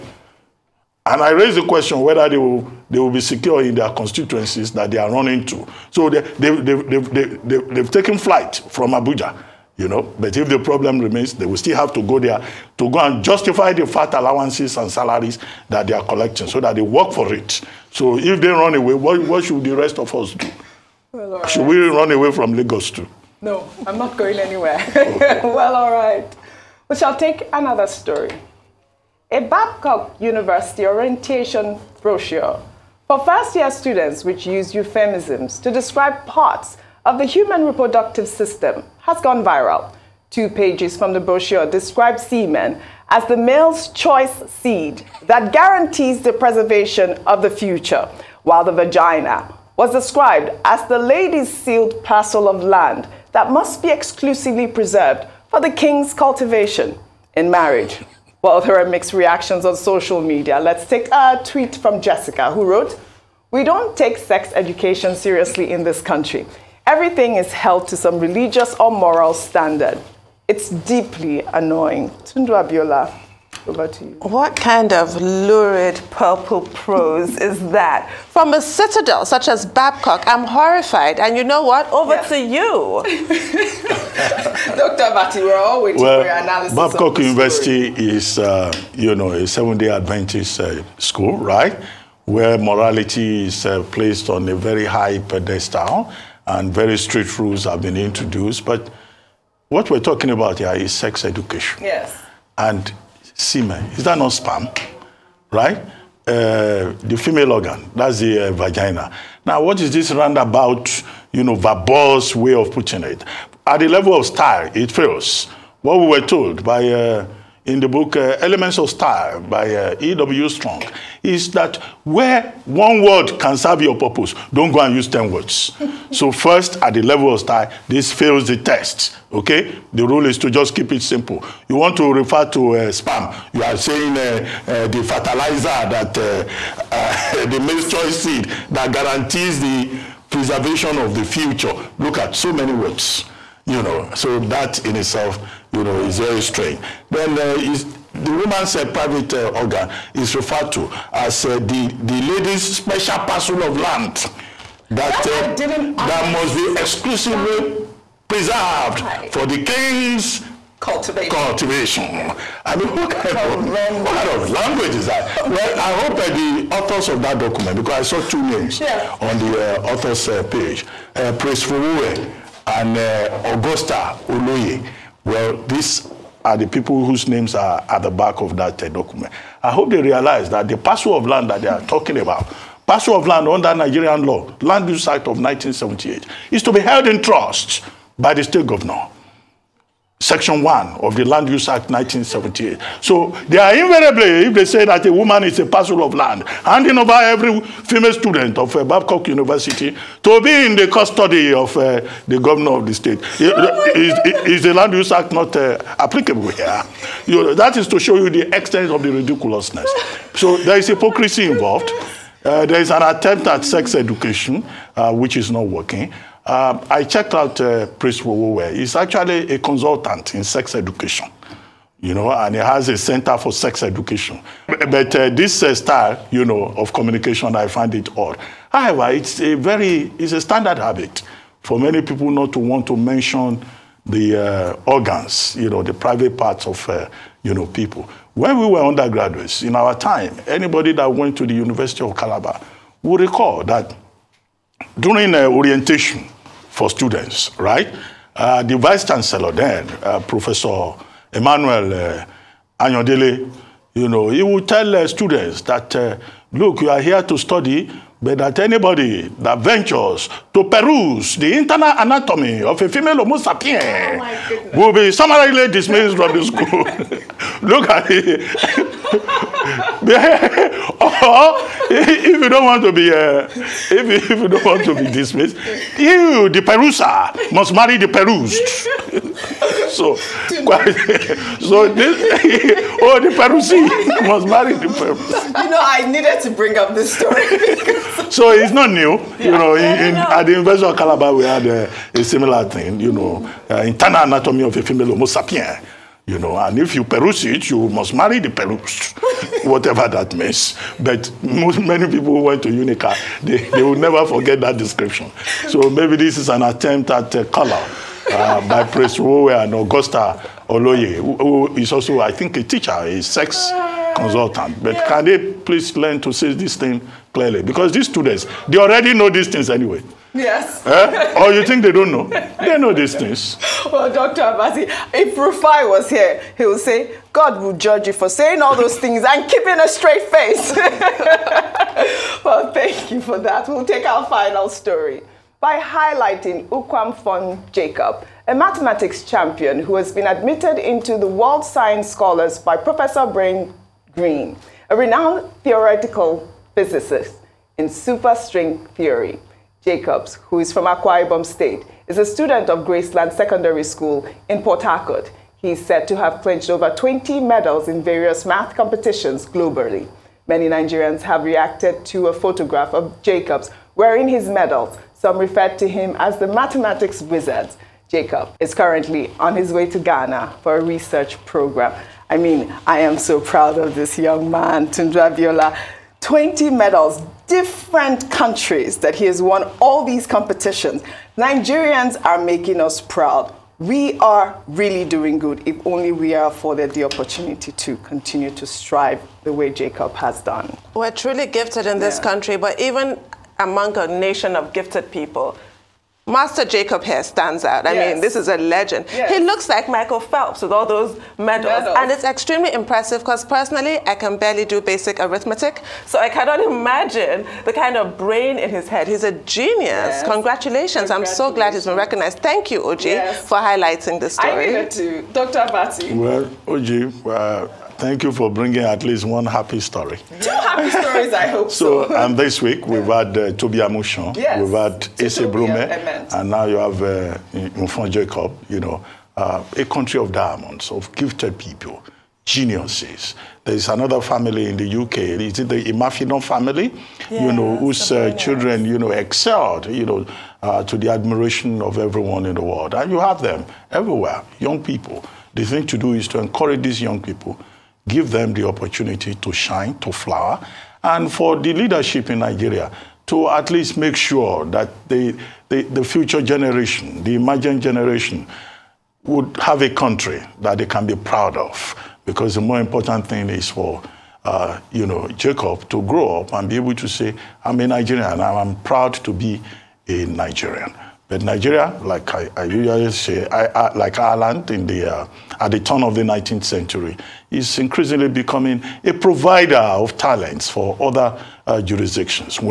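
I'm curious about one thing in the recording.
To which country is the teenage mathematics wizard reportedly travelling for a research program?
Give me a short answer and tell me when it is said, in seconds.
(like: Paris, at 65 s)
Ghana, at 369 s.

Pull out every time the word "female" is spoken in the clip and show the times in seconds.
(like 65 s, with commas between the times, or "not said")
107 s, 197 s, 262 s, 294 s.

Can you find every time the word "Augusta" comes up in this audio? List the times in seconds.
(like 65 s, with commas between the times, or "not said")
173 s, 309 s.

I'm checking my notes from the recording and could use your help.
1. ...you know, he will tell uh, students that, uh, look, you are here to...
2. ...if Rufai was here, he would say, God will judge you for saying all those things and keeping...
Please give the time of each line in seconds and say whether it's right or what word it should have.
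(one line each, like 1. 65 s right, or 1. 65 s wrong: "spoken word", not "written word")
1. 253 s right
2. 325 s right.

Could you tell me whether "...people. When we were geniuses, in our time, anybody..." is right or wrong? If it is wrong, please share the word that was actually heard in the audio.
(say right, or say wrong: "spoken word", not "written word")
wrong: "undergraduates", not "geniuses".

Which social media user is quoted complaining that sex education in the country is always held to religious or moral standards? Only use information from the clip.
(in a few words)
Jessica.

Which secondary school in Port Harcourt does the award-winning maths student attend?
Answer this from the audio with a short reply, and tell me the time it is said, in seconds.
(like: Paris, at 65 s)
Graceland Secondary School, at 352 s.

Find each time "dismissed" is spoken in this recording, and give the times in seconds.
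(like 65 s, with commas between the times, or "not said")
265 s, 275 s.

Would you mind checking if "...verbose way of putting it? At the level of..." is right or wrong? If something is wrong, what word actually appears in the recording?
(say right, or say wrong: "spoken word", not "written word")
right.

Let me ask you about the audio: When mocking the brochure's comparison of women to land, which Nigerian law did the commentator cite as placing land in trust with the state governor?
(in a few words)
Land Use Act 1978.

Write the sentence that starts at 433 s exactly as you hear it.
There's another family in the UK, is it the Imafidon family?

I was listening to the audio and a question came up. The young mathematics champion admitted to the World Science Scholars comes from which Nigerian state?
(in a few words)
Akwa Ibom.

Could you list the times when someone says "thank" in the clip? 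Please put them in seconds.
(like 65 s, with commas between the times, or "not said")
332 s, 412 s, 418 s.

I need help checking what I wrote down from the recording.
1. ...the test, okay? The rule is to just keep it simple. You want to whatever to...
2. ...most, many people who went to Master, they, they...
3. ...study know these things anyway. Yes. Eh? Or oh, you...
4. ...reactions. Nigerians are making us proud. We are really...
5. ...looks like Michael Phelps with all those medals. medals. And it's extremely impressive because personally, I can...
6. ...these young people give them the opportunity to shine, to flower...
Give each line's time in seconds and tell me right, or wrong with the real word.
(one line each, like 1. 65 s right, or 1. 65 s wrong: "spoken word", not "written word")
1. 128 s wrong: "refer", not "whatever"
2. 301 s wrong: "UNICA", not "Master"
3. 318 s wrong: "already", not "study"
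4. 380 s wrong: "competitions", not "reactions"
5. 399 s right
6. 446 s right.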